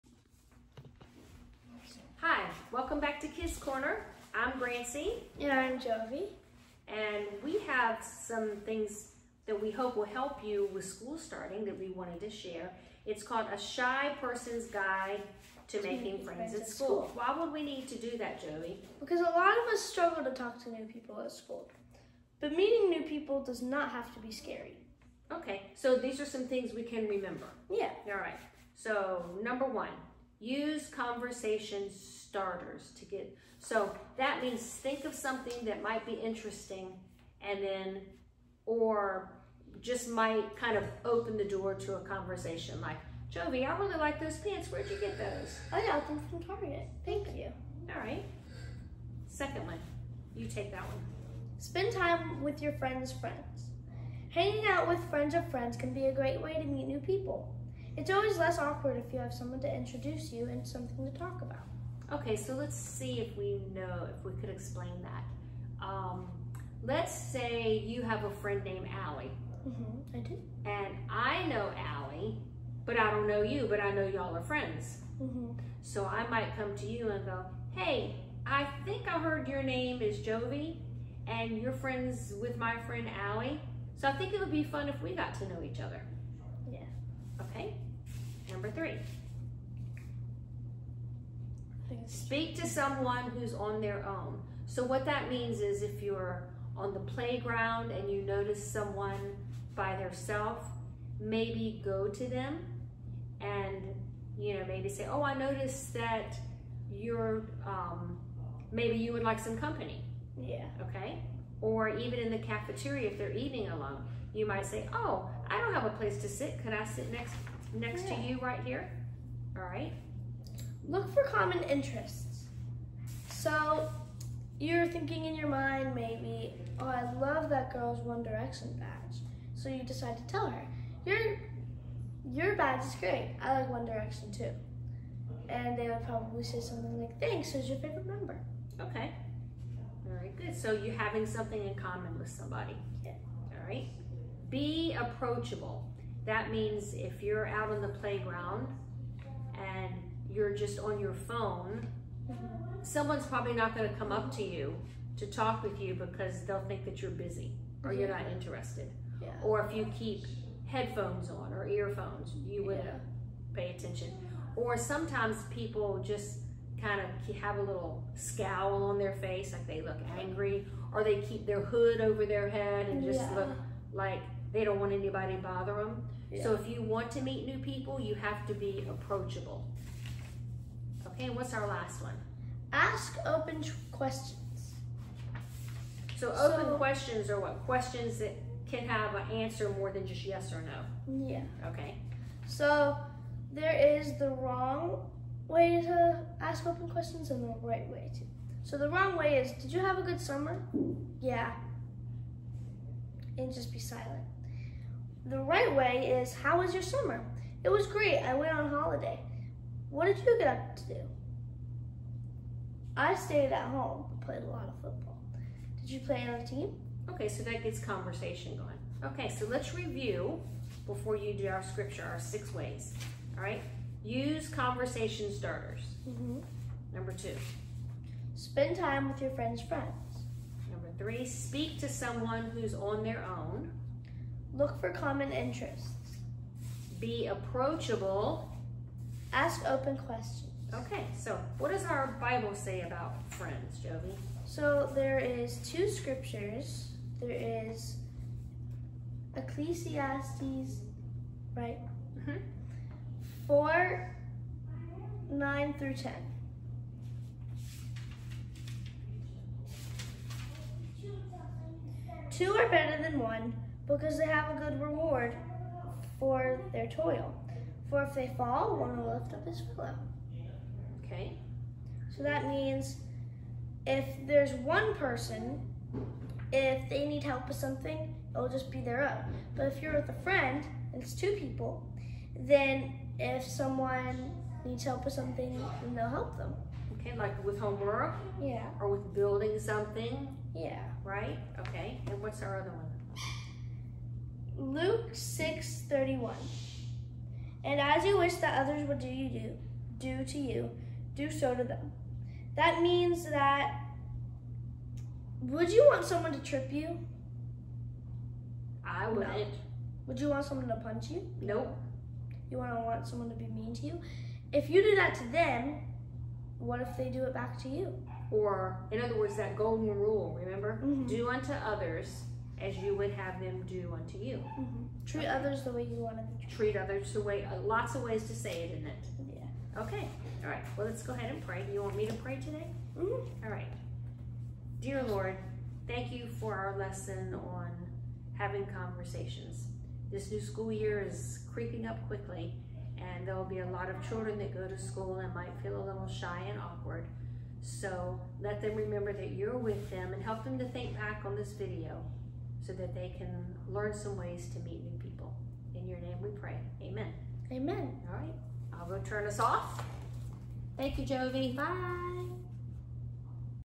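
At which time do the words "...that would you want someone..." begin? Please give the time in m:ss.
5:03.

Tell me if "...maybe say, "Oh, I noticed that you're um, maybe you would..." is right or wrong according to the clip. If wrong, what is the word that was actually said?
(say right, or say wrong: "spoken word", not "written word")
right.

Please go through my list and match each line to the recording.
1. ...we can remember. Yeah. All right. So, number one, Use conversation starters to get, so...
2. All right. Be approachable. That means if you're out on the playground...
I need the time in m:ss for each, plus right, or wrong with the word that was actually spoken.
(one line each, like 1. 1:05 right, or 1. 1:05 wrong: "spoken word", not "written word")
1. 0:26 right
2. 2:23 right.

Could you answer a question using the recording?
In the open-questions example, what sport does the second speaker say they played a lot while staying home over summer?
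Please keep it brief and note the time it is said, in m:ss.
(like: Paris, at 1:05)
Football, at 3:34.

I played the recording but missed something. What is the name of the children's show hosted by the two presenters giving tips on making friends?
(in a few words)
Kidz Korner.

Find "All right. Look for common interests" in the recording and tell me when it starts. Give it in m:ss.
1:59.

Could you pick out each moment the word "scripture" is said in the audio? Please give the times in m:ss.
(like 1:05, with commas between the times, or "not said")
3:41, 4:05.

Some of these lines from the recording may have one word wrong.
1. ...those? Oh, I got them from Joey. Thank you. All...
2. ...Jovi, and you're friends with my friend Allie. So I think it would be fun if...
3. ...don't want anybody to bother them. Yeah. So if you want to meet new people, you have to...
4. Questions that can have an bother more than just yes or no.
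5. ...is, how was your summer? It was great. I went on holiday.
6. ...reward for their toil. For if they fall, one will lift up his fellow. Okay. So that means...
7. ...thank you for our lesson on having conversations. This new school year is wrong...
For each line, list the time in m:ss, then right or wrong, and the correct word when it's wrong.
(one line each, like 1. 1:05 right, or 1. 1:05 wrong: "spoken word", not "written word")
1. 0:45 wrong: "Target", not "Joey"
2. 1:20 right
3. 2:54 right
4. 3:07 wrong: "answer", not "bother"
5. 3:26 right
6. 4:24 right
7. 5:35 wrong: "creeping", not "wrong".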